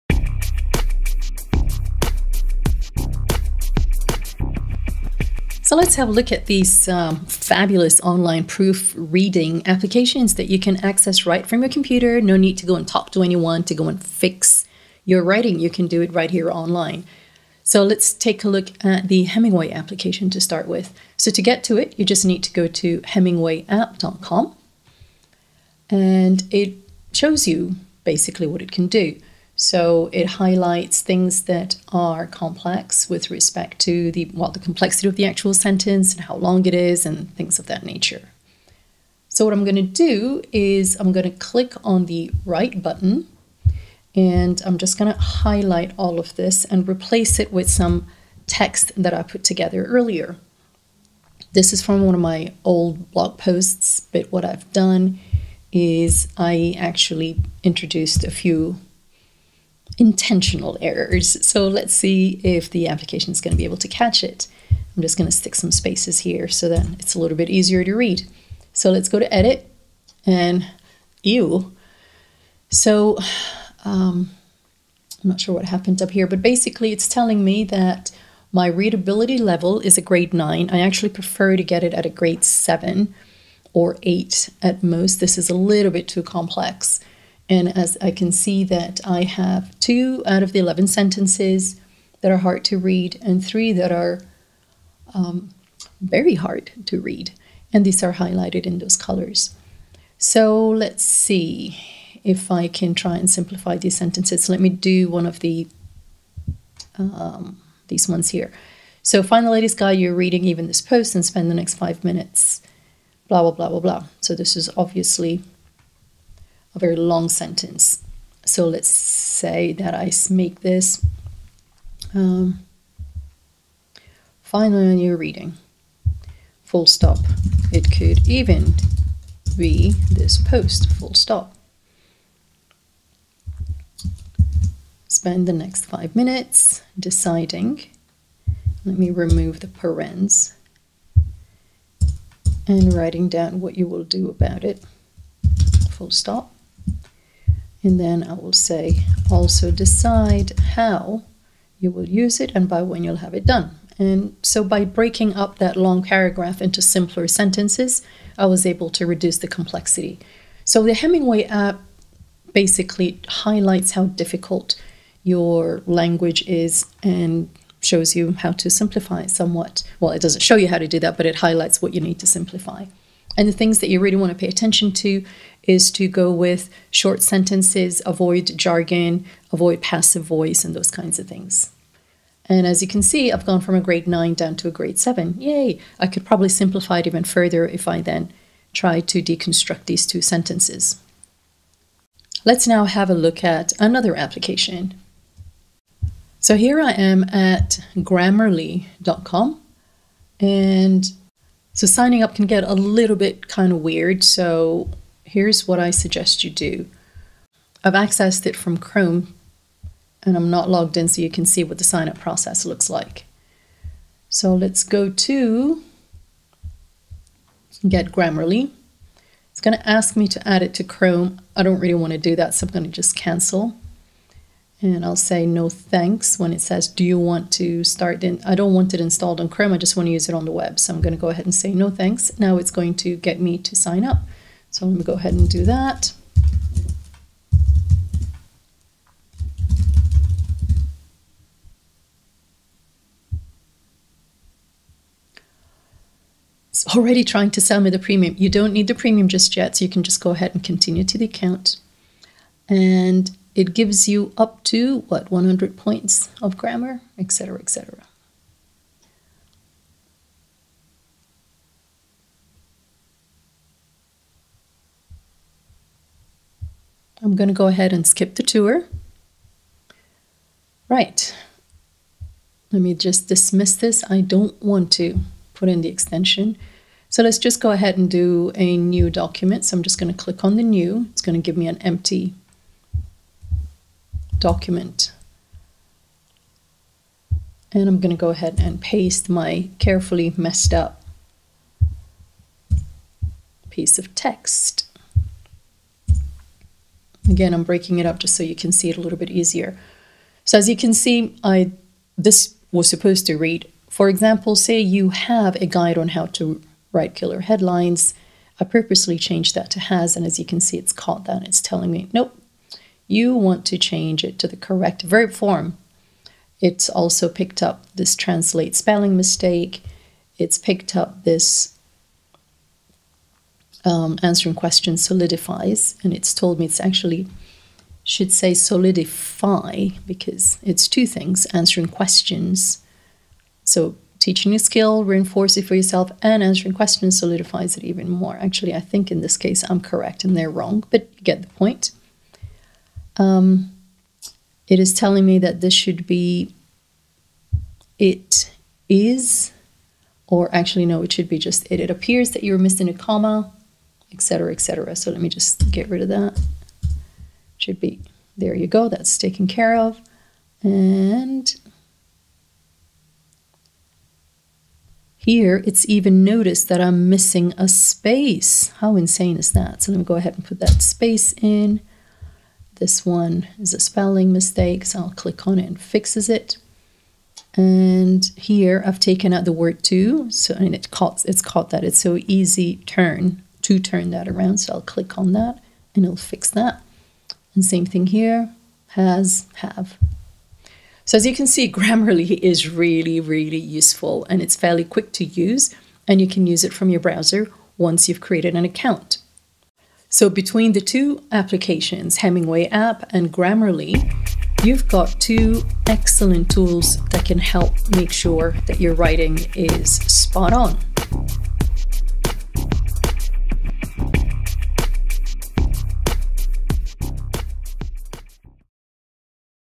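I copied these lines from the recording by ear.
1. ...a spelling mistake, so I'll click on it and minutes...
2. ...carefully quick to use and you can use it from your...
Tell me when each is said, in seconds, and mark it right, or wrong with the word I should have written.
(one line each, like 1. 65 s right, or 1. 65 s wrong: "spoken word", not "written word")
1. 373 s wrong: "fixes", not "minutes"
2. 394 s wrong: "fairly", not "carefully".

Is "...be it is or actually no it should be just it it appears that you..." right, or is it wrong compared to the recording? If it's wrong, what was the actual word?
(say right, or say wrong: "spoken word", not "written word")
right.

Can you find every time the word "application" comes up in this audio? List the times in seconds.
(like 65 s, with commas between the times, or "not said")
9 s, 19 s, 62 s, 194 s, 401 s.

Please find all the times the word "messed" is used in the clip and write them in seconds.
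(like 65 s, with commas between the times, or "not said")
290 s.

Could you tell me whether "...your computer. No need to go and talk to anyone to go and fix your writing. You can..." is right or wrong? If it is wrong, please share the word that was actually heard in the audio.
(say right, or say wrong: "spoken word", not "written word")
right.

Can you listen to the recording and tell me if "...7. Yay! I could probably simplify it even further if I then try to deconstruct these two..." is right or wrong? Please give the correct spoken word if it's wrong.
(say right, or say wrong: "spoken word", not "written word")
right.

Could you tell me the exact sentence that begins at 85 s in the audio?
This is a little bit too complex.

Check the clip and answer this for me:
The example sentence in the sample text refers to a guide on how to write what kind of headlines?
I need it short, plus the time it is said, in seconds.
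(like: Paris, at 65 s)
killer headlines, at 307 s.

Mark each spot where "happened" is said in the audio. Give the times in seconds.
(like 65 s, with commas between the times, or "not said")
75 s.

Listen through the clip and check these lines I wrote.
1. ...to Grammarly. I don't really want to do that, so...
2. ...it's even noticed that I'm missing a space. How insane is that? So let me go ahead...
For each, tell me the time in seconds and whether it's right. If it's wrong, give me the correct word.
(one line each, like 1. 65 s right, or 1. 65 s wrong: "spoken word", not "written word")
1. 220 s wrong: "Chrome", not "Grammarly"
2. 365 s right.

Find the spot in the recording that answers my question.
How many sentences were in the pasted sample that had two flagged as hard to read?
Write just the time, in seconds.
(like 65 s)
90 s.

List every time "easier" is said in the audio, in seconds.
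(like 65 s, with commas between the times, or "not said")
67 s, 299 s.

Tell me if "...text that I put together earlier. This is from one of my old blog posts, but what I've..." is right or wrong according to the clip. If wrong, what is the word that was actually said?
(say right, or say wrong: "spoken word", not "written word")
right.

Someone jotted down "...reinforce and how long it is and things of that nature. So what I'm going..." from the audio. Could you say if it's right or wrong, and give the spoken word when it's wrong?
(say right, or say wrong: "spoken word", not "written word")
wrong: "sentence", not "reinforce".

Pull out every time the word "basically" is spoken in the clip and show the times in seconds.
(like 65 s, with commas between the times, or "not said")
28 s, 76 s, 162 s.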